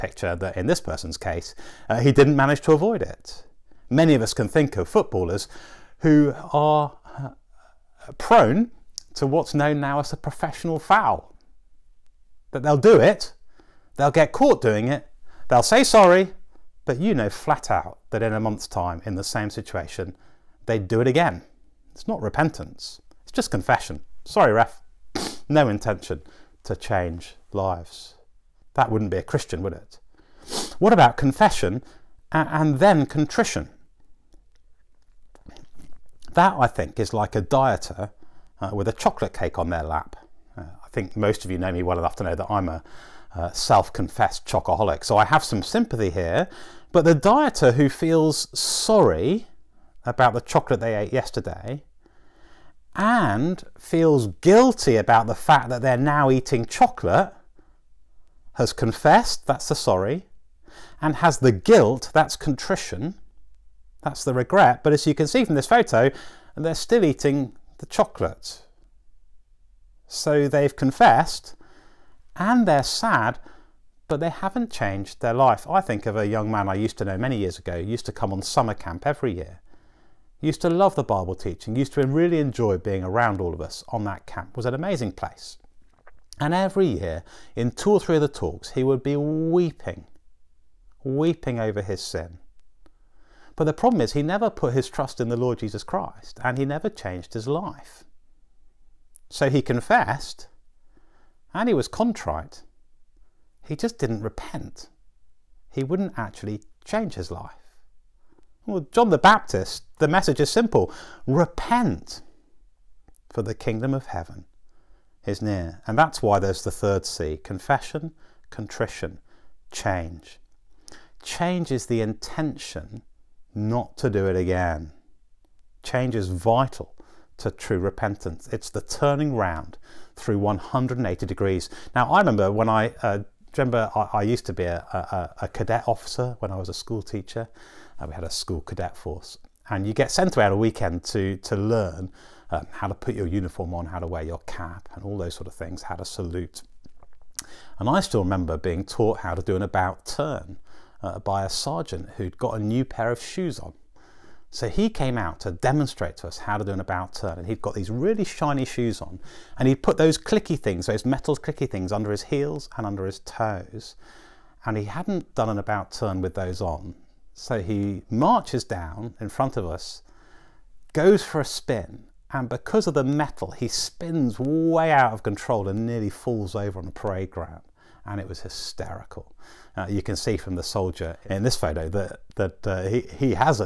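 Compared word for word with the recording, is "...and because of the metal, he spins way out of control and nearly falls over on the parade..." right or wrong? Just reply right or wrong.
right.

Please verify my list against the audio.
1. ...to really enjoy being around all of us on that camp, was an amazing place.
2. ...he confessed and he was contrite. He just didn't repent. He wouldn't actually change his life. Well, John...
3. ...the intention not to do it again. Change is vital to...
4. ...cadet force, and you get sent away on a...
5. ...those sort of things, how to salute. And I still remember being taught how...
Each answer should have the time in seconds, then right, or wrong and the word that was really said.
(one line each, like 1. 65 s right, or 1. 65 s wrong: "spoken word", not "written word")
1. 81 s right
2. 99 s right
3. 121 s right
4. 138 s right
5. 145 s right.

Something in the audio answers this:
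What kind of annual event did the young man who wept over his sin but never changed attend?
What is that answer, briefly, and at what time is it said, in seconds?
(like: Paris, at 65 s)
summer camp, at 78 s.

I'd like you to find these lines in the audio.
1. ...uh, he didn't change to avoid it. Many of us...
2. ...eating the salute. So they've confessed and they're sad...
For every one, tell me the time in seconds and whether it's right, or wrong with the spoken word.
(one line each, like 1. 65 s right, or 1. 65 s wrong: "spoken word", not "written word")
1. 1 s wrong: "manage", not "change"
2. 67 s wrong: "chocolate", not "salute".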